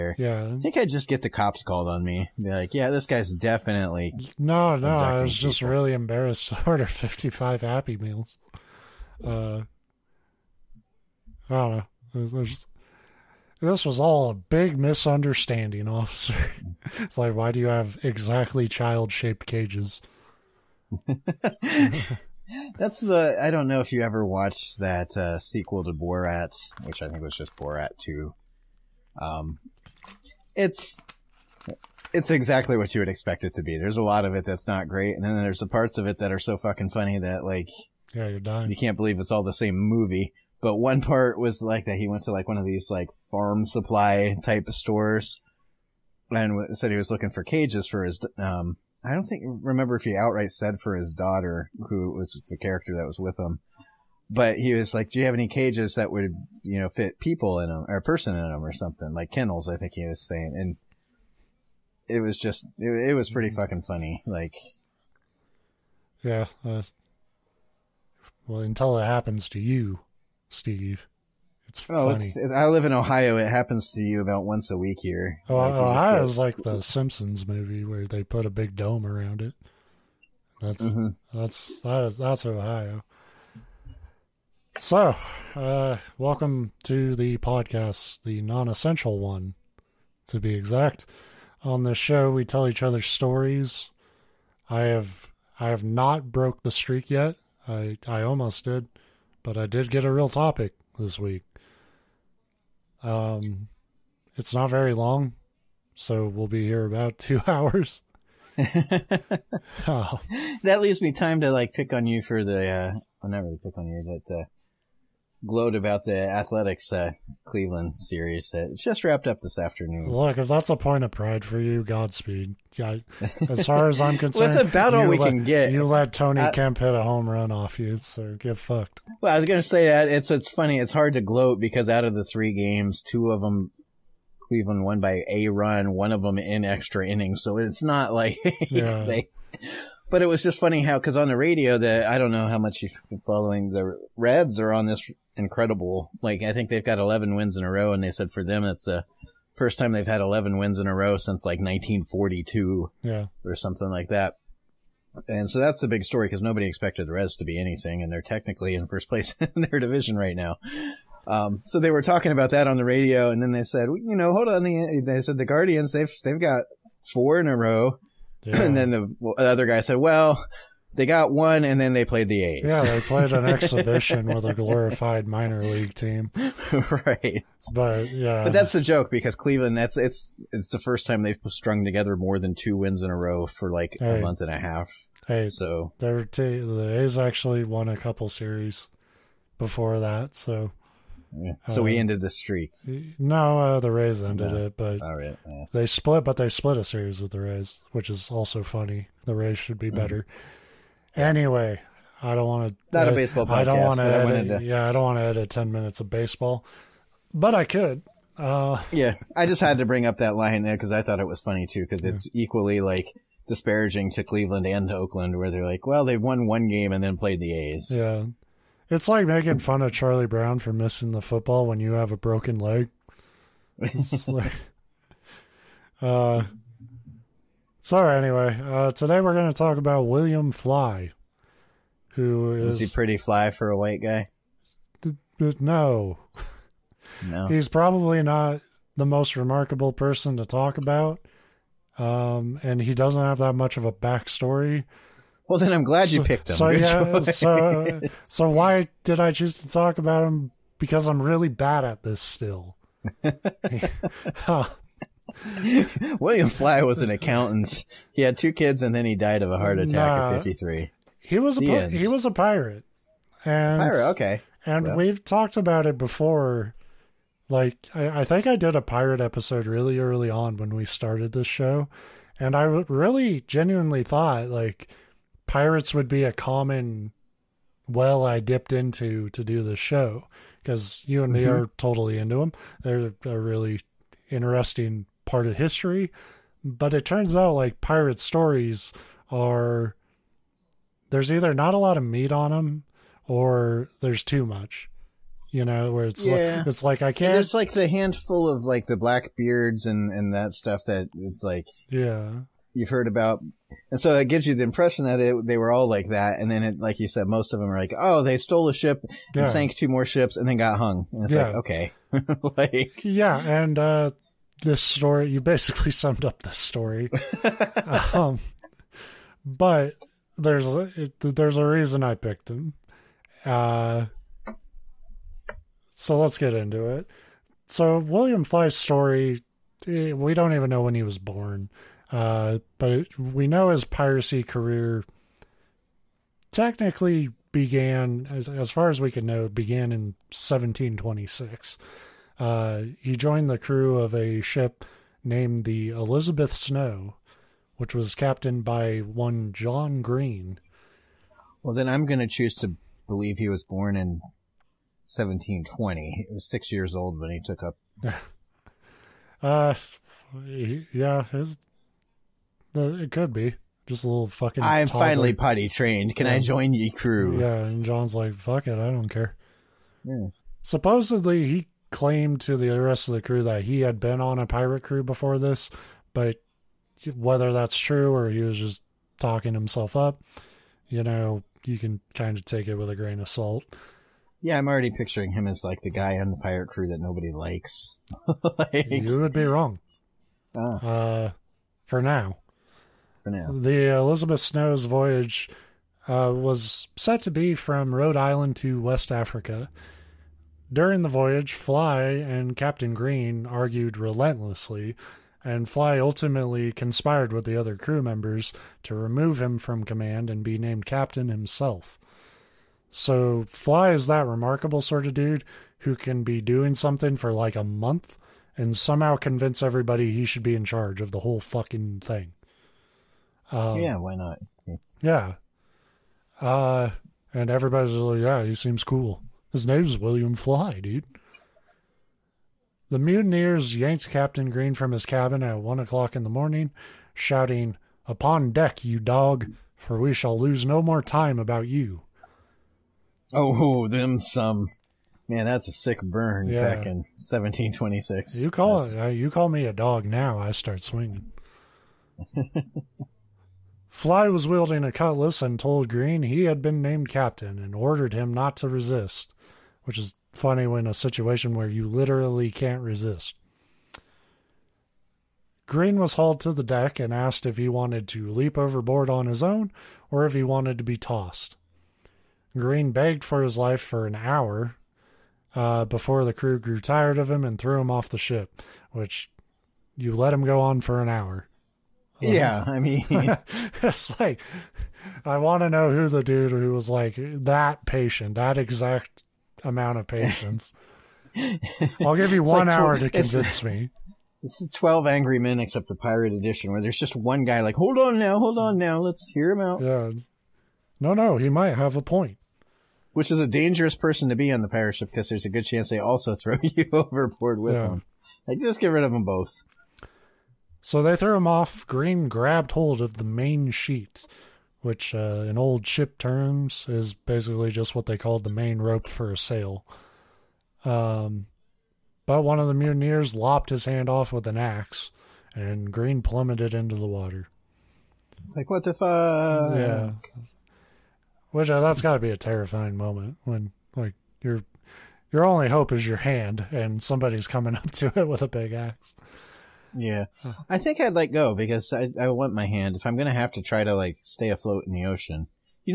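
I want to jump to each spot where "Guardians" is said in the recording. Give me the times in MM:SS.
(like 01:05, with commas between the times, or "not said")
02:45.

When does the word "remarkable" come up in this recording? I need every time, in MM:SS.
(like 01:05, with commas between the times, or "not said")
03:59, 06:54.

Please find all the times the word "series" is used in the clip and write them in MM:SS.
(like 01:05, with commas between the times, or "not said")
01:57, 03:08, 03:16.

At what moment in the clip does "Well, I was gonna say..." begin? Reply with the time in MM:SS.
02:09.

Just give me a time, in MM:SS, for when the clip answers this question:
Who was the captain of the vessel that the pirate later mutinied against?
05:49.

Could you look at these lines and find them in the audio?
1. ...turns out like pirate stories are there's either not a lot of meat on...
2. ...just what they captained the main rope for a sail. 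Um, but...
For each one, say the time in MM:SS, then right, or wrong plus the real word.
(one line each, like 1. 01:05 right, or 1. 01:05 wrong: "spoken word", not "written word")
1. 04:47 right
2. 08:37 wrong: "called", not "captained".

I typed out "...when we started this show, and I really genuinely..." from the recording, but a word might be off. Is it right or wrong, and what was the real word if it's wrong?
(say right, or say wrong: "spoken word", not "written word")
right.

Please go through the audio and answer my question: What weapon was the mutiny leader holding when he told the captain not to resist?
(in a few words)
A cutlass.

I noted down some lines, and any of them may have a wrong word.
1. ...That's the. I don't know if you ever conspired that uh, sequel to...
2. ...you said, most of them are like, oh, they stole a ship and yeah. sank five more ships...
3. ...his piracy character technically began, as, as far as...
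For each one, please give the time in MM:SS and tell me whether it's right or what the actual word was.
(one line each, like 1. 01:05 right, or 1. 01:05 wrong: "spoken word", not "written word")
1. 00:22 wrong: "watched", not "conspired"
2. 05:06 wrong: "two", not "five"
3. 05:33 wrong: "career", not "character".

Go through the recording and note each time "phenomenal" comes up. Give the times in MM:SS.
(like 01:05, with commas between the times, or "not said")
not said.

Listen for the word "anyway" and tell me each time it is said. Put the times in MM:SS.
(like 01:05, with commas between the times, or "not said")
03:21, 03:48.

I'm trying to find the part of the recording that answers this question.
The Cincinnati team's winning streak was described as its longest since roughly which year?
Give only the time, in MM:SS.
02:31.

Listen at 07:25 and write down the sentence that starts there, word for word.
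Man, that's a sick burn yeah.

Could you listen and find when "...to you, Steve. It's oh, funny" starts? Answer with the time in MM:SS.
01:09.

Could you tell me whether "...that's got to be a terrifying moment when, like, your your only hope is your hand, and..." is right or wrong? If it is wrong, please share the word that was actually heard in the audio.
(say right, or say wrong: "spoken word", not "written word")
right.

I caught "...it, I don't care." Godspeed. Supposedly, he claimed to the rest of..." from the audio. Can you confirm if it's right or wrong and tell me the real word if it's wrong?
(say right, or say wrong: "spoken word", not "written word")
wrong: "Yeah", not "Godspeed".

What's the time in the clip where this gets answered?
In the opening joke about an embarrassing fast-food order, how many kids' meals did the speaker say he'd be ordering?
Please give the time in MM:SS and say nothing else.
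00:06.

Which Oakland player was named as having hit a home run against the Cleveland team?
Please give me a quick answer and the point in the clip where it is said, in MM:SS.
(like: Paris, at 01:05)
Tony Kemp, at 02:06.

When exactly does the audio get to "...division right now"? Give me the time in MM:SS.
02:39.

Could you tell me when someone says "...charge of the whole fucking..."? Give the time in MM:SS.
07:00.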